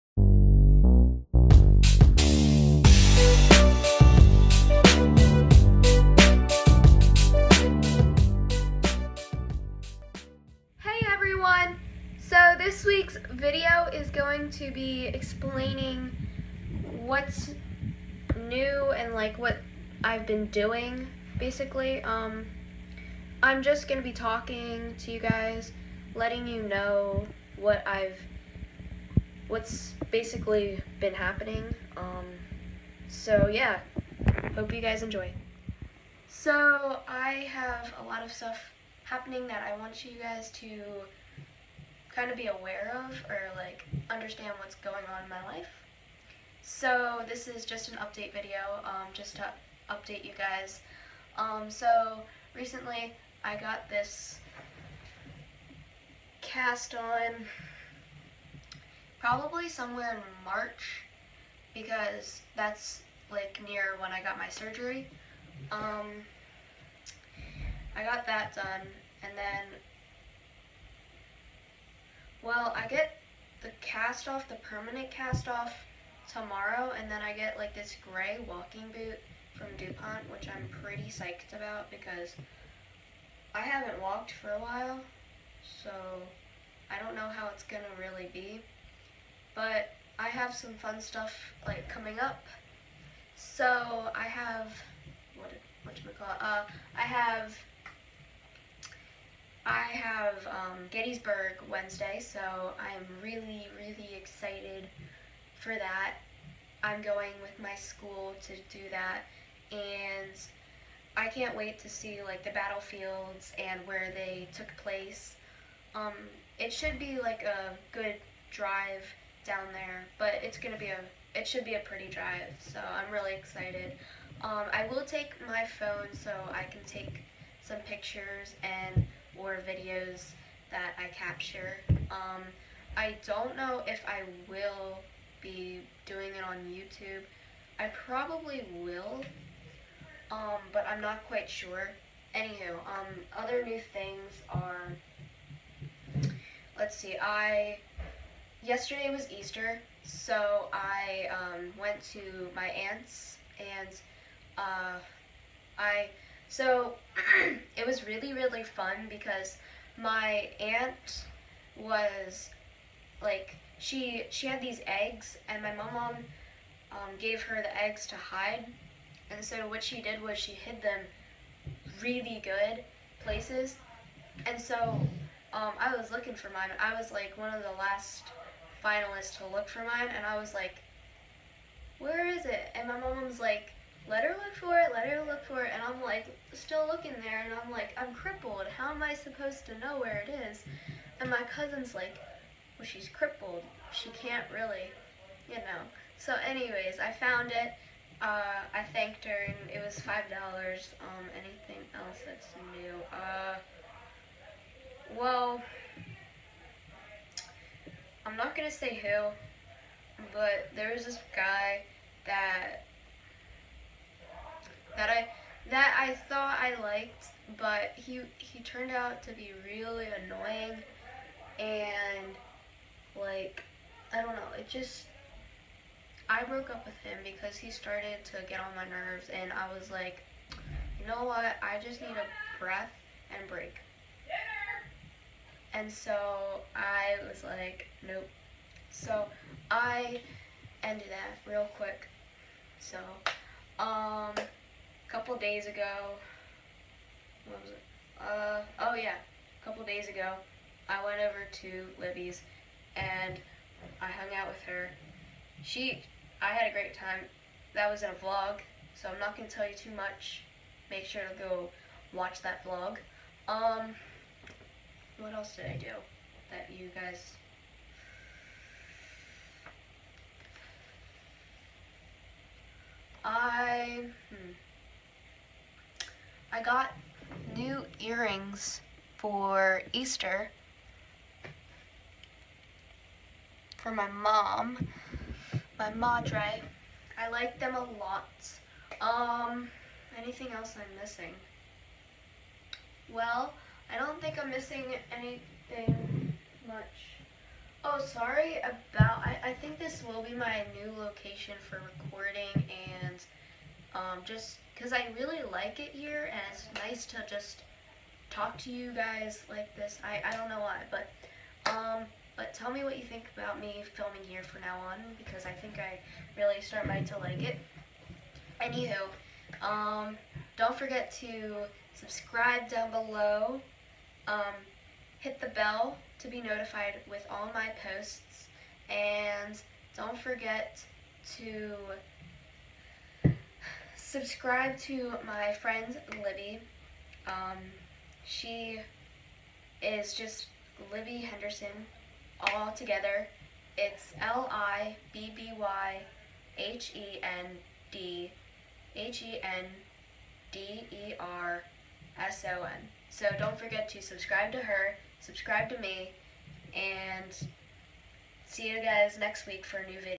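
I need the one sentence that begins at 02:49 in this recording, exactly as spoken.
And so what she did was she hid them really good places.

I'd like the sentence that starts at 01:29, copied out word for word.
But I have some fun stuff like coming up.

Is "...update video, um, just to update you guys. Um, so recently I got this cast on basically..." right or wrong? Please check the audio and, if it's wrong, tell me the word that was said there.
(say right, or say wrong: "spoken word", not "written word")
wrong: "probably", not "basically".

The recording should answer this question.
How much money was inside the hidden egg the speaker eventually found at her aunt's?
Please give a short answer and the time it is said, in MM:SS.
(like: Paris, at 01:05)
$5, at 03:19.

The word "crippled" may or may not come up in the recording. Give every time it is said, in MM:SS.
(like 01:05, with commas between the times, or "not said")
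03:08, 03:13.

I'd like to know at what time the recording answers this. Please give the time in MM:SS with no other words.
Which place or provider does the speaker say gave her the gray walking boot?
01:19.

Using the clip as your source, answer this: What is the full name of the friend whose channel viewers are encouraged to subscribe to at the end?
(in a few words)
Libby Henderson.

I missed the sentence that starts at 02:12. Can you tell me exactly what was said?
Um, I don't know if I will be doing it on YouTube.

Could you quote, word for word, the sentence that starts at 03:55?
And so I was like, nope.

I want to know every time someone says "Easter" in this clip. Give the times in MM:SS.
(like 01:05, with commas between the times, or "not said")
02:29, 04:39.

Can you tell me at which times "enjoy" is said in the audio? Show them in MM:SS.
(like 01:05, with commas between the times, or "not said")
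00:35.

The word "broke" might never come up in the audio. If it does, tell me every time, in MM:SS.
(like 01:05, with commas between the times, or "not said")
03:46.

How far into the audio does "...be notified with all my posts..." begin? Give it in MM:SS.
05:26.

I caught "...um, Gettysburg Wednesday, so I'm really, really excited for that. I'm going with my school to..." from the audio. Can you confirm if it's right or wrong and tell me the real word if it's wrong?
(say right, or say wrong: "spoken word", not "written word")
right.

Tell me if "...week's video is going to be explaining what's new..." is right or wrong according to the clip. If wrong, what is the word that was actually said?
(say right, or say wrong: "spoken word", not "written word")
right.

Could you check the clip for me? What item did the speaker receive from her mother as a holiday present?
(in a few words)
Earrings.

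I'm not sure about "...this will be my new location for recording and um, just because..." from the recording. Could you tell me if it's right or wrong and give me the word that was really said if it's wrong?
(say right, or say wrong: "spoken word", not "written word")
right.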